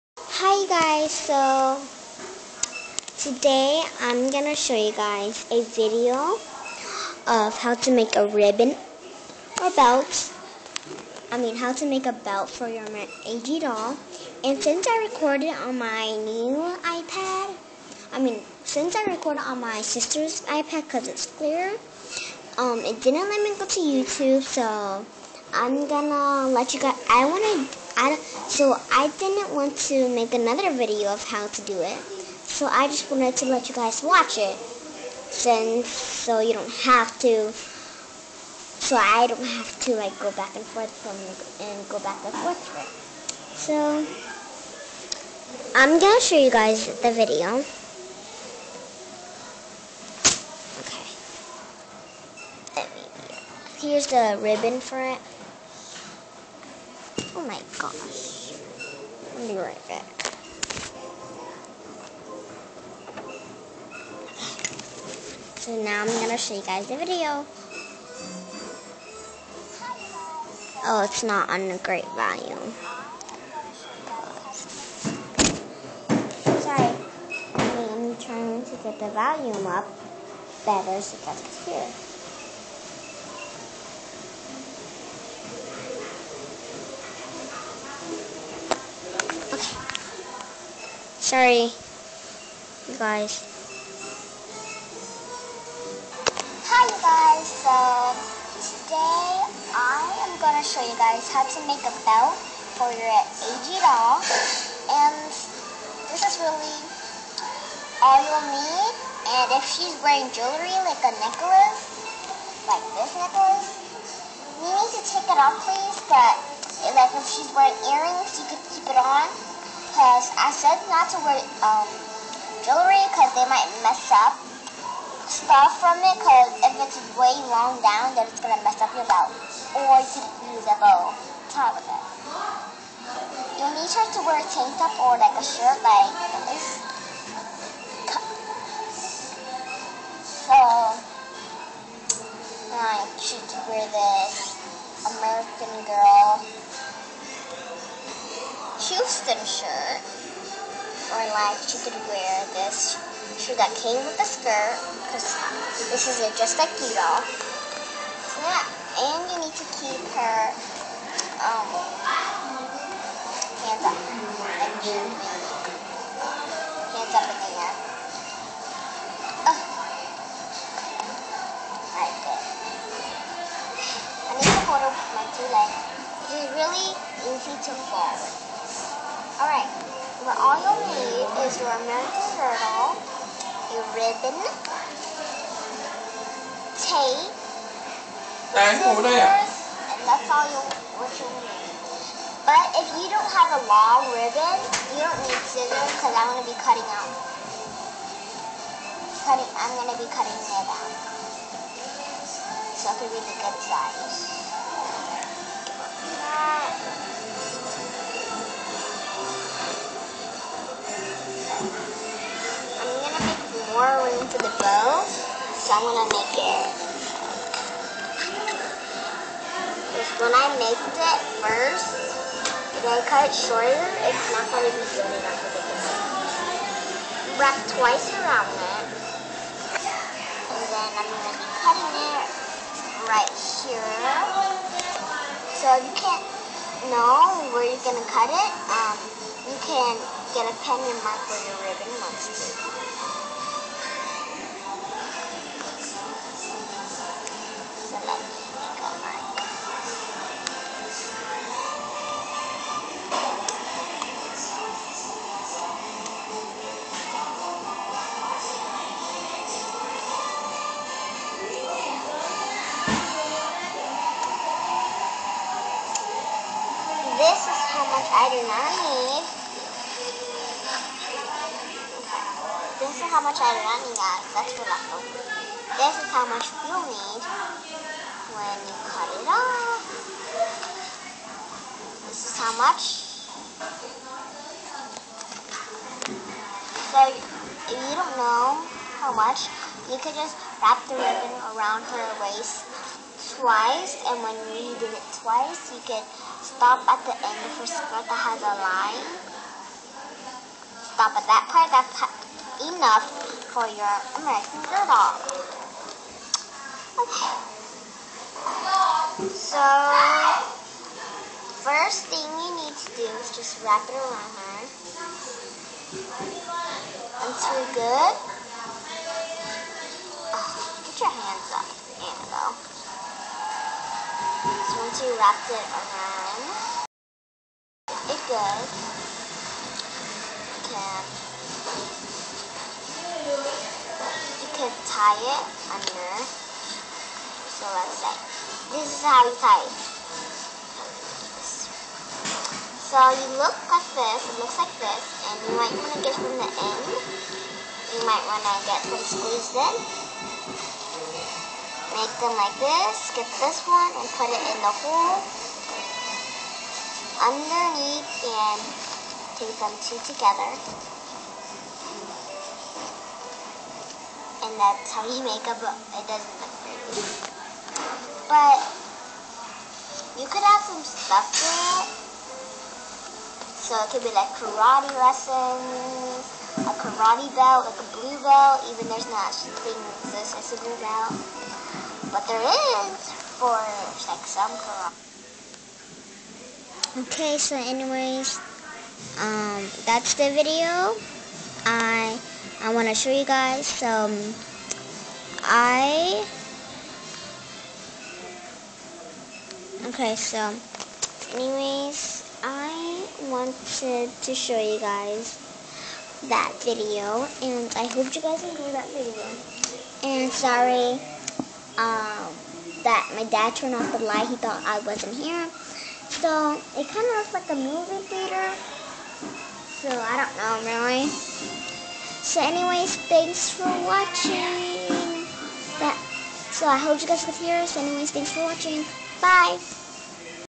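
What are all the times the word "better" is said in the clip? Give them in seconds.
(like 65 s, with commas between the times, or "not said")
80 s.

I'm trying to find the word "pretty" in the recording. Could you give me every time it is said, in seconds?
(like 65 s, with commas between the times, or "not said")
366 s.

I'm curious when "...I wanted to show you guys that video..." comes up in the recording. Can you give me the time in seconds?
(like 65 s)
402 s.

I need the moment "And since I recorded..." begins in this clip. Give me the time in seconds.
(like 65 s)
14 s.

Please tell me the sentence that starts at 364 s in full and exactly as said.
And that's how you make a book.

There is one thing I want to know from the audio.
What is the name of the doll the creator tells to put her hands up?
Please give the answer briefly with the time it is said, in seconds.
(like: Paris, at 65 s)
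Annabelle, at 322 s.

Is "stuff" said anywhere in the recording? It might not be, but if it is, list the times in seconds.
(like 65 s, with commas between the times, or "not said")
125 s, 370 s.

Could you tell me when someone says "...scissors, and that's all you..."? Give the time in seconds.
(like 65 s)
188 s.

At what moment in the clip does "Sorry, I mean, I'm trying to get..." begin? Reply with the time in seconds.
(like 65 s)
76 s.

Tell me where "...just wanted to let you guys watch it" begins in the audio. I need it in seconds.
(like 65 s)
32 s.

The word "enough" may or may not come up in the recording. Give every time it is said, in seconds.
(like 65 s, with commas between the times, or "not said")
225 s, 302 s.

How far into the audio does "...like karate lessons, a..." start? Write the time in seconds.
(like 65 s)
374 s.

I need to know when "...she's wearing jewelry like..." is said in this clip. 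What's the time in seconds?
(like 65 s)
109 s.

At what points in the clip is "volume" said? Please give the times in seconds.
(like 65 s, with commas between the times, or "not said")
72 s, 79 s.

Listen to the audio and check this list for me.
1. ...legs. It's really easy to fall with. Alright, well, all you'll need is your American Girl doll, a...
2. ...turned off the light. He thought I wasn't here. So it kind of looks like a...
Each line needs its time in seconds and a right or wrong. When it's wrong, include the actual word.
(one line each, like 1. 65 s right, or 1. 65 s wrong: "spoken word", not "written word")
1. 175 s right
2. 413 s right.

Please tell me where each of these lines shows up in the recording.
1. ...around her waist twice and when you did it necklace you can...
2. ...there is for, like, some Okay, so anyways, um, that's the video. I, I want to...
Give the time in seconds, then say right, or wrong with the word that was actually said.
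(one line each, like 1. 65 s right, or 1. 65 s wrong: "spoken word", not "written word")
1. 291 s wrong: "twice", not "necklace"
2. 382 s right.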